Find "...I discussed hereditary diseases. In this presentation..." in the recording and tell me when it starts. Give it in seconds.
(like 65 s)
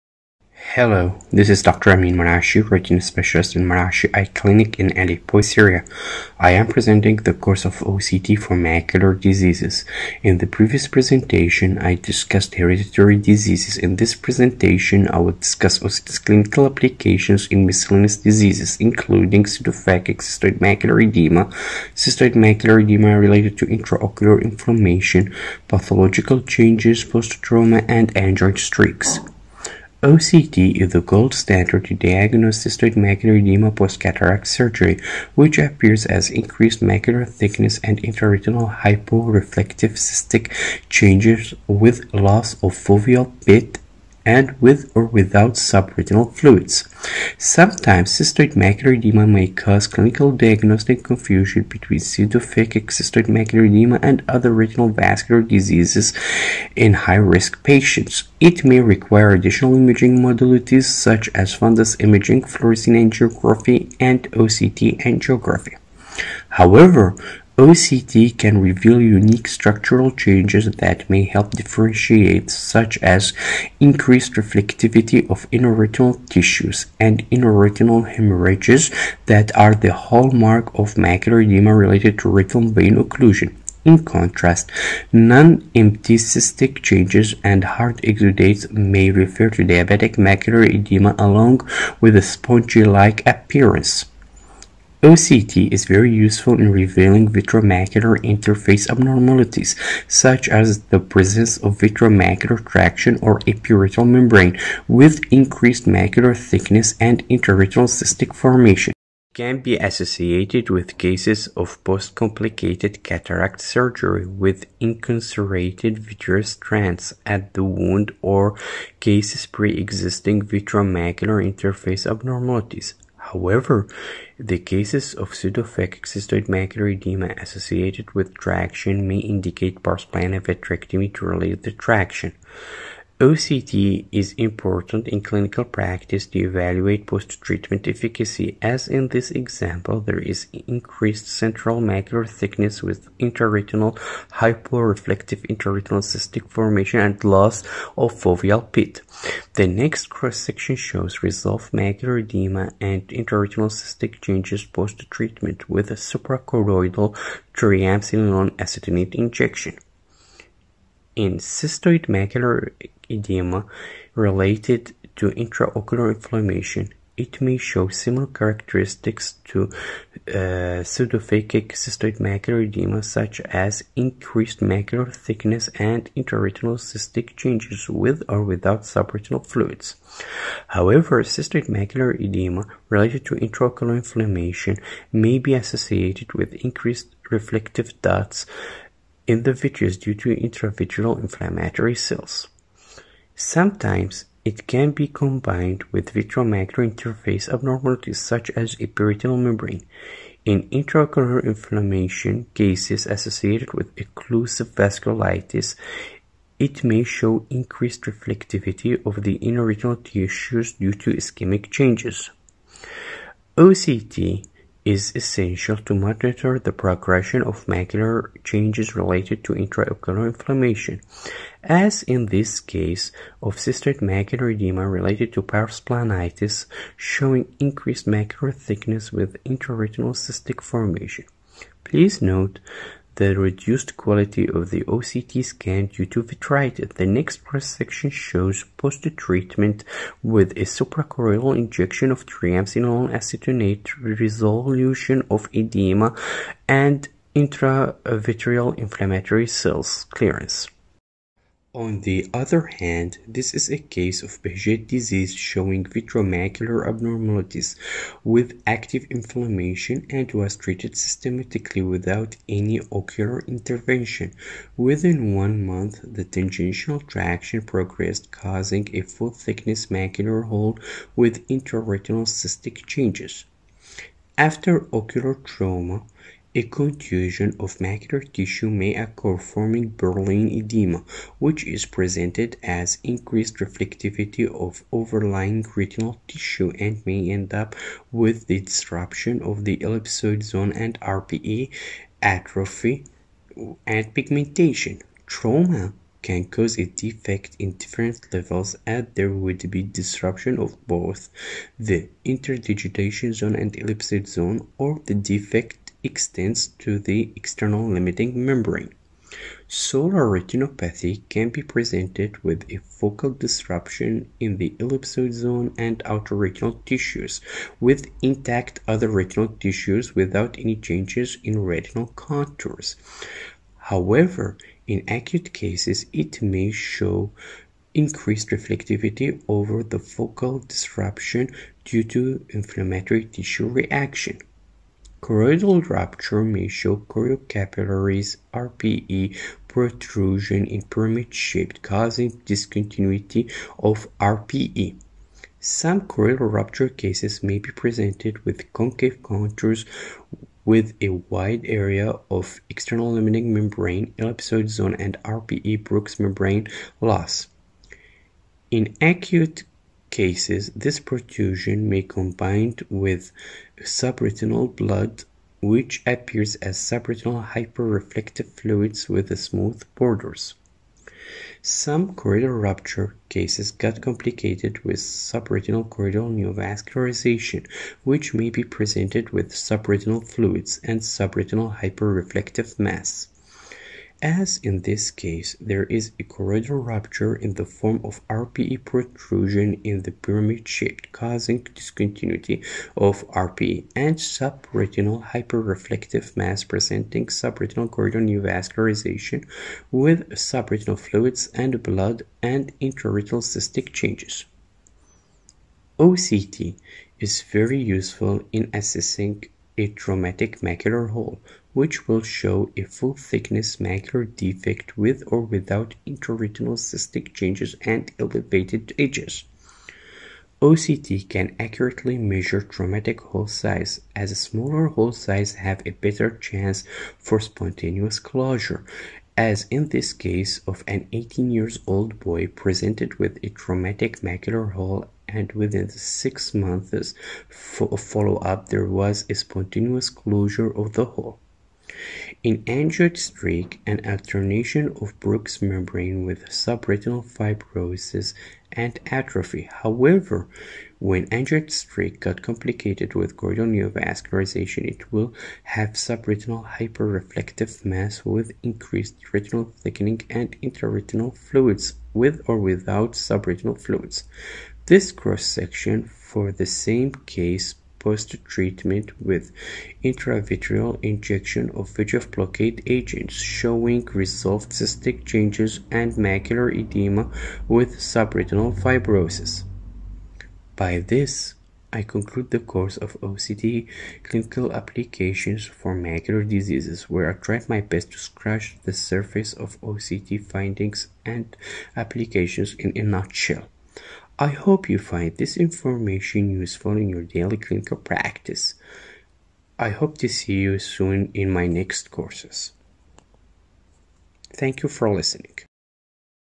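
11 s.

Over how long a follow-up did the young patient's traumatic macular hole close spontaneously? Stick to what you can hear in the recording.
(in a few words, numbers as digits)
6 months.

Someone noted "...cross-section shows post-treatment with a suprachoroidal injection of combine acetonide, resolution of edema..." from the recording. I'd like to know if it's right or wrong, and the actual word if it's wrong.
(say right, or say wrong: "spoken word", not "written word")
wrong: "triamcinolone", not "combine".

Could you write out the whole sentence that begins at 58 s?
It may require additional imaging modalities such as fundus imaging, fluorescein angiography, and OCT angiography.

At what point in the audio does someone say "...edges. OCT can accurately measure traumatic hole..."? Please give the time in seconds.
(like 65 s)
418 s.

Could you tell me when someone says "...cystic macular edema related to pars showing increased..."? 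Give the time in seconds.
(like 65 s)
223 s.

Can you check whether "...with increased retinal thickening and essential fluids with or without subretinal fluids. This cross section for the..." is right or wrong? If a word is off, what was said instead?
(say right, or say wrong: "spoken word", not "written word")
wrong: "intraretinal", not "essential".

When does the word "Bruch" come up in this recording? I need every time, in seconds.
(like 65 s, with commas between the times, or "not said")
355 s, 445 s.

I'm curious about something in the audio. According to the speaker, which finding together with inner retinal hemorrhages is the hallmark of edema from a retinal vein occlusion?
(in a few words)
Increased reflectivity of inner retinal tissues.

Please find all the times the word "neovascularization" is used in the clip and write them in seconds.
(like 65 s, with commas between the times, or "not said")
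376 s, 398 s, 453 s.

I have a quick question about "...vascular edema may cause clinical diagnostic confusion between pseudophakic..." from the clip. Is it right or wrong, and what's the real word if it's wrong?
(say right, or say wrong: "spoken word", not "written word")
wrong: "macular", not "vascular".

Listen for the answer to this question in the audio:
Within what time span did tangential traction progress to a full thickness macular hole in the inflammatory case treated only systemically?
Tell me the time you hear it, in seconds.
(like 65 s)
265 s.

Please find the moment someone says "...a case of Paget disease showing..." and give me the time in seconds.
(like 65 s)
253 s.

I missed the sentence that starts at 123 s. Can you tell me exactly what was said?
However, the cases of pseudophakic cystoid macular edema associated with traction may indicate plana vitrectomy to relieve the traction.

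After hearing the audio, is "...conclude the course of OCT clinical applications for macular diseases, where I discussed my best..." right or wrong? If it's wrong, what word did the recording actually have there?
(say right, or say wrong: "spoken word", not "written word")
wrong: "tried", not "discussed".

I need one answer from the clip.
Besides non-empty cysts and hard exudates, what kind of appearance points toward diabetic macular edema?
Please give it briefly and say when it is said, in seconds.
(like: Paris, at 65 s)
Spongy-like appearance, at 92 s.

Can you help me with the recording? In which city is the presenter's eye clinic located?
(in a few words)
Aleppo.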